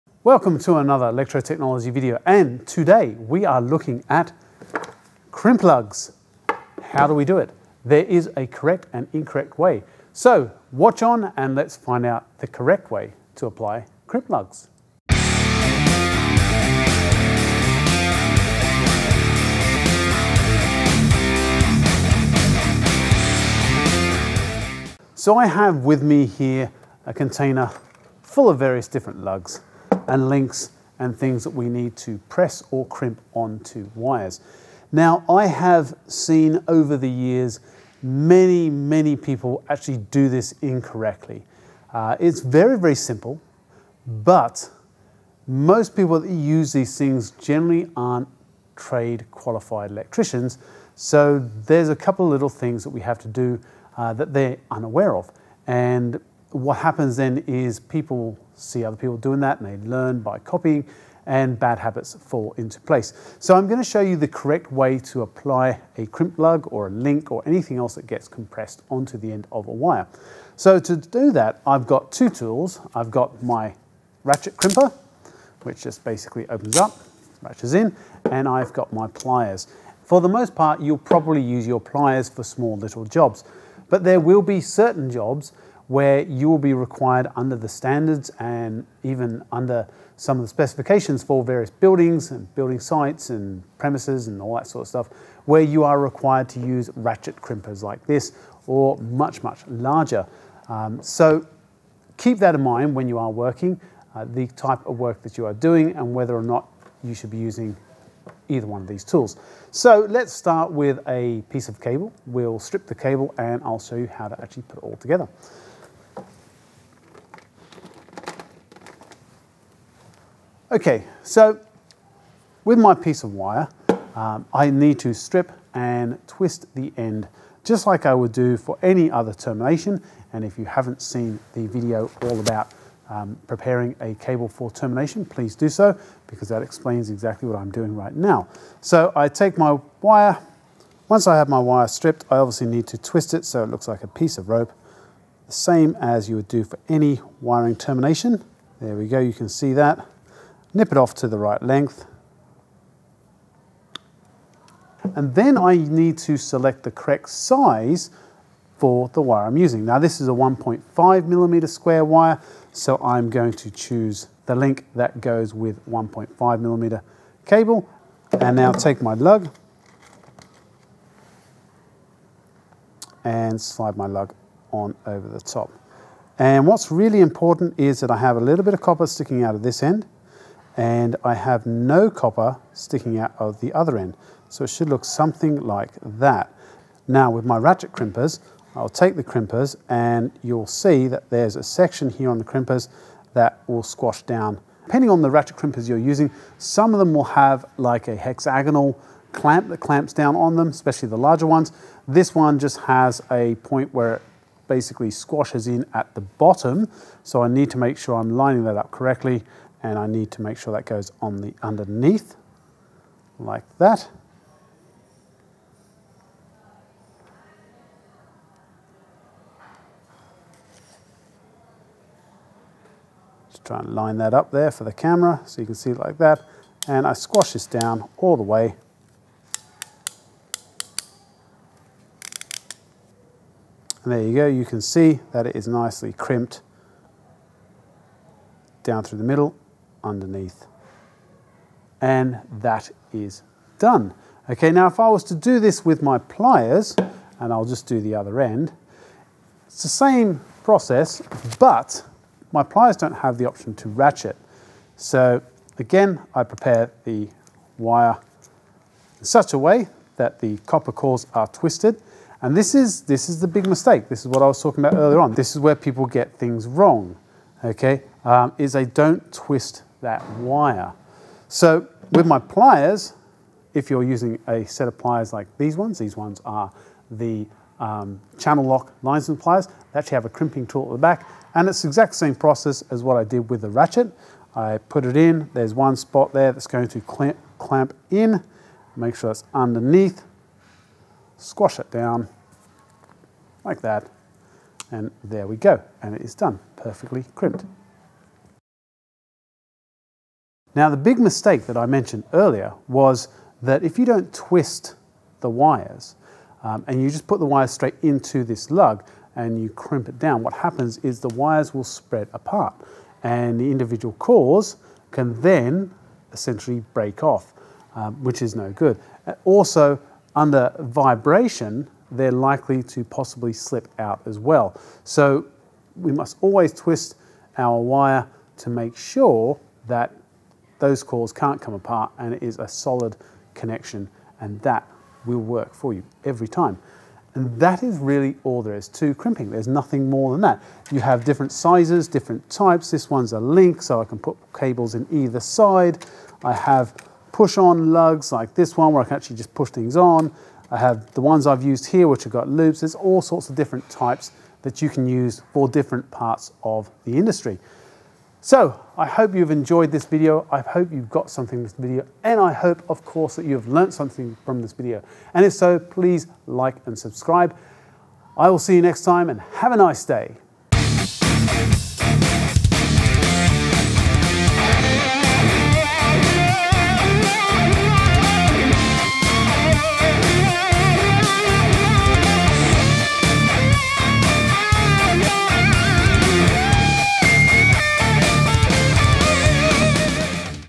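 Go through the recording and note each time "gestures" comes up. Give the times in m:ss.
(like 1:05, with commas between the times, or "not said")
not said.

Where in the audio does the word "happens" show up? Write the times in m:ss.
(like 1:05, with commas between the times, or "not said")
0:56, 5:10.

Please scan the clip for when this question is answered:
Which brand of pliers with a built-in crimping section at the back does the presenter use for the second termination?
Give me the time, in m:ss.
4:38.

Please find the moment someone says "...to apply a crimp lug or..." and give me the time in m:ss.
1:04.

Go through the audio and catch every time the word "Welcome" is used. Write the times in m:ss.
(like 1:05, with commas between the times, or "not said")
0:00.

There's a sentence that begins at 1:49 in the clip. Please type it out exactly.
So let's start with a piece of cable.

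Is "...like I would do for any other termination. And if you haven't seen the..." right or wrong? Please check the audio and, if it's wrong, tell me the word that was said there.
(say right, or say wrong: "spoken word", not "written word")
right.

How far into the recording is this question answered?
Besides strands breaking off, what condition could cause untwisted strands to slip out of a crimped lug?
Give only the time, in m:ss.
5:20.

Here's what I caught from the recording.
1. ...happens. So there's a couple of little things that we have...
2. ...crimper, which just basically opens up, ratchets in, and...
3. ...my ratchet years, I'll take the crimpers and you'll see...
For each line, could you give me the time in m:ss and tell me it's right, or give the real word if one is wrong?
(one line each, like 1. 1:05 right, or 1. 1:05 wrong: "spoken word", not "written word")
1. 0:49 wrong: "electricians", not "happens"
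2. 1:14 right
3. 3:07 wrong: "crimpers", not "years".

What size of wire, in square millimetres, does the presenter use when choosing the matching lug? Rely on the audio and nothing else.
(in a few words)
1.5 mm².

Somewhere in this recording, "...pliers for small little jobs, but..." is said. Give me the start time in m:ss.
1:21.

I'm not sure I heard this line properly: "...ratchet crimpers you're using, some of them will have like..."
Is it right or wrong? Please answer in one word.
right.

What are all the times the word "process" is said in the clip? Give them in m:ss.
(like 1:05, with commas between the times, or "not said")
4:10, 4:42.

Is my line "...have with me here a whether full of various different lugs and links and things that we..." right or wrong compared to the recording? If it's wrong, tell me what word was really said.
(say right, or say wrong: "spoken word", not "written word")
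wrong: "container", not "whether".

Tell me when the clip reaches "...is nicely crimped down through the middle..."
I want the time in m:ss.
3:55.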